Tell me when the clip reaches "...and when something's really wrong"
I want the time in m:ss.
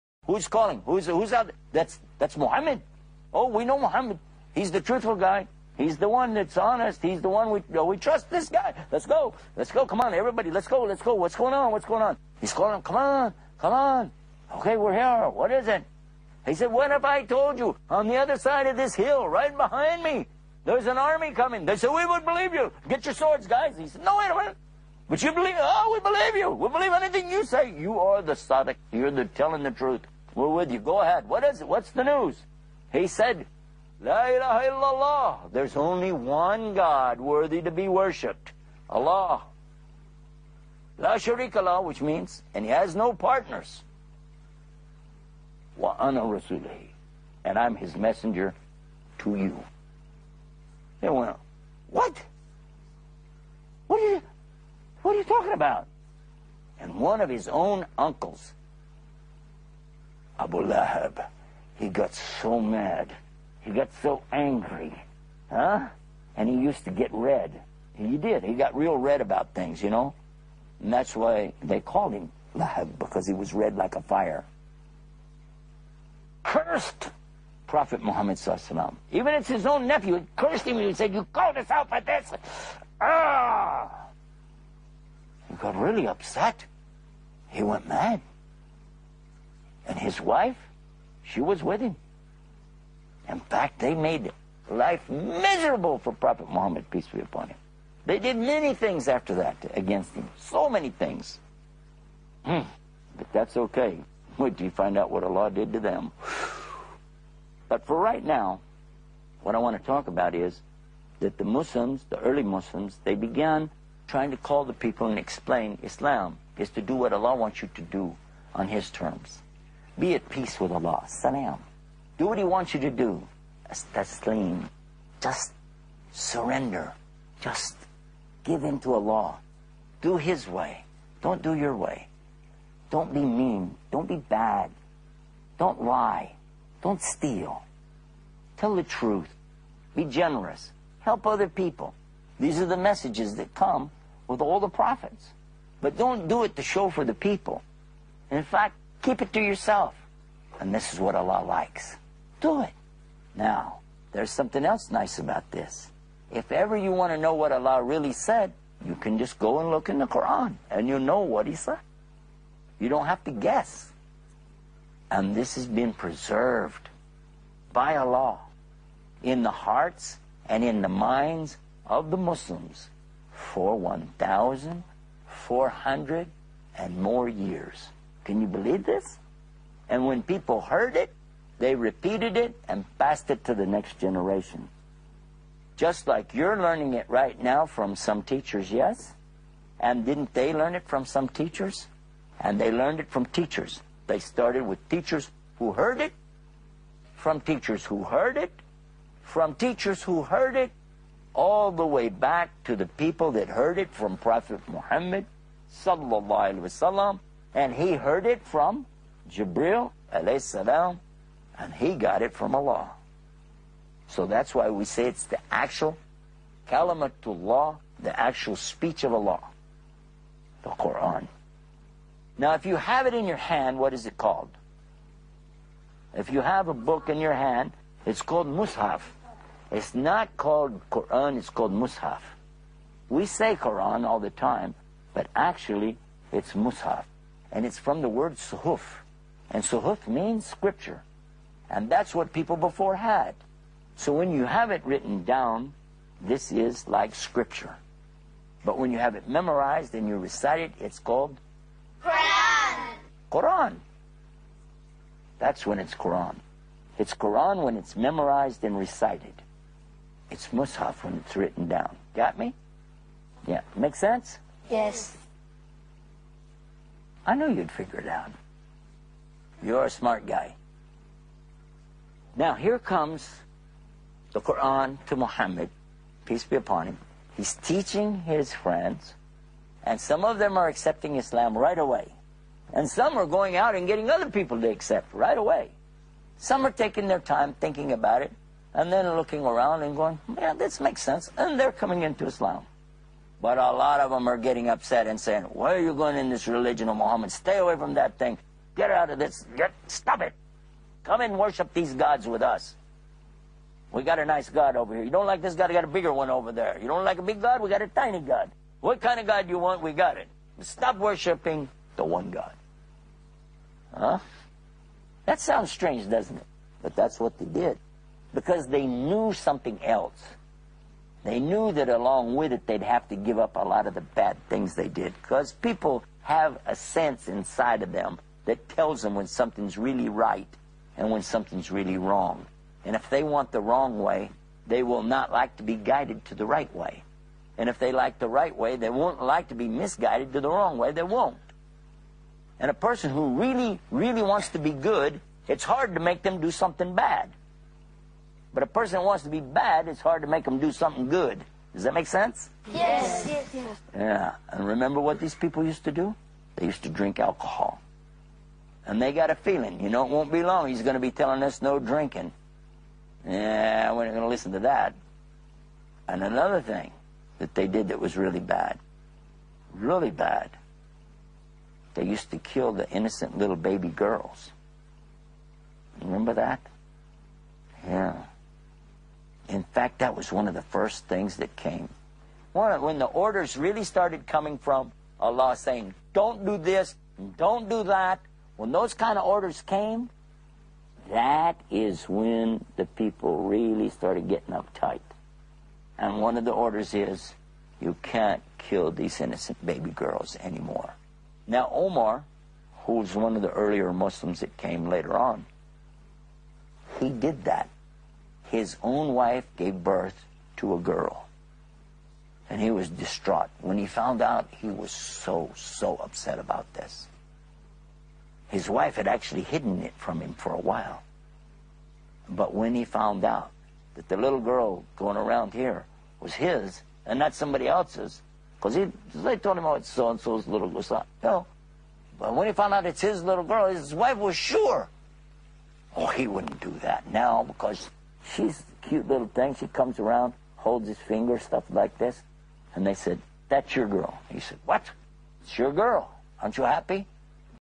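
5:30.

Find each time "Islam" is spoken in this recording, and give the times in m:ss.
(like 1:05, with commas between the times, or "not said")
1:55, 4:41, 4:52.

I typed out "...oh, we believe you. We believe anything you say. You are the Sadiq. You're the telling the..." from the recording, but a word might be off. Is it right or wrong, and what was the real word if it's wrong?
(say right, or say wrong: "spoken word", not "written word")
right.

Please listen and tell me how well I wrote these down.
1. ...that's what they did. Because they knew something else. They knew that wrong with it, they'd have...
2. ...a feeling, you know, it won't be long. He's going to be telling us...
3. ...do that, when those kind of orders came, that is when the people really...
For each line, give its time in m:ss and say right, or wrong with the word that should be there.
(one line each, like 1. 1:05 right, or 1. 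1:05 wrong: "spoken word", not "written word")
1. 5:16 wrong: "along", not "wrong"
2. 5:59 right
3. 6:27 right.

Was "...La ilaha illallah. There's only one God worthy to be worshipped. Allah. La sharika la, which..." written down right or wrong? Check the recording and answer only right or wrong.
right.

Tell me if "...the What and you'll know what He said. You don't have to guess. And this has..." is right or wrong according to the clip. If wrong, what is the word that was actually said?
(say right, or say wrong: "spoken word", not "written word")
wrong: "Quran", not "What".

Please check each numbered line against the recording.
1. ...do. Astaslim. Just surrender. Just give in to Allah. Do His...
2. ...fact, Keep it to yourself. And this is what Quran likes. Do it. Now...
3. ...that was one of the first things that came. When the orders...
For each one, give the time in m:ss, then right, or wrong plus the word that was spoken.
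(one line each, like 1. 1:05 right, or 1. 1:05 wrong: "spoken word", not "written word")
1. 2:02 right
2. 2:28 wrong: "Allah", not "Quran"
3. 6:19 right.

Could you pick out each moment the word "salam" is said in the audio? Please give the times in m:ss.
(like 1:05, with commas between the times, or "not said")
2:01, 3:30.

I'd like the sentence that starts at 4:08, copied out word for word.
But when you have it memorized and you recite it, it's called Quran.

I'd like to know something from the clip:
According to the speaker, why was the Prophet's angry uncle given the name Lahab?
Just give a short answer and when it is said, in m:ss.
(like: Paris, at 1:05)
He was red like a fire, at 1:13.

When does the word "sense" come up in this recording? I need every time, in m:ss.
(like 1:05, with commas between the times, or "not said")
4:23, 4:51, 5:26, 5:52.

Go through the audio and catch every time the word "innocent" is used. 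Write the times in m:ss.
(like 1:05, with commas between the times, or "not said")
6:12, 6:39.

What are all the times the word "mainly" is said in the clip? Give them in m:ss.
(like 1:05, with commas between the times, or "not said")
not said.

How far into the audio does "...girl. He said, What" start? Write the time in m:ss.
7:23.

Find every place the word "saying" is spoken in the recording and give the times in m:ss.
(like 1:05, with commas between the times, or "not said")
4:55, 6:25.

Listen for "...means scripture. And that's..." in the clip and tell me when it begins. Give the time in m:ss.
4:00.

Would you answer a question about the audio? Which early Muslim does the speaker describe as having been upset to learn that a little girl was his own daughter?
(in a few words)
Omar.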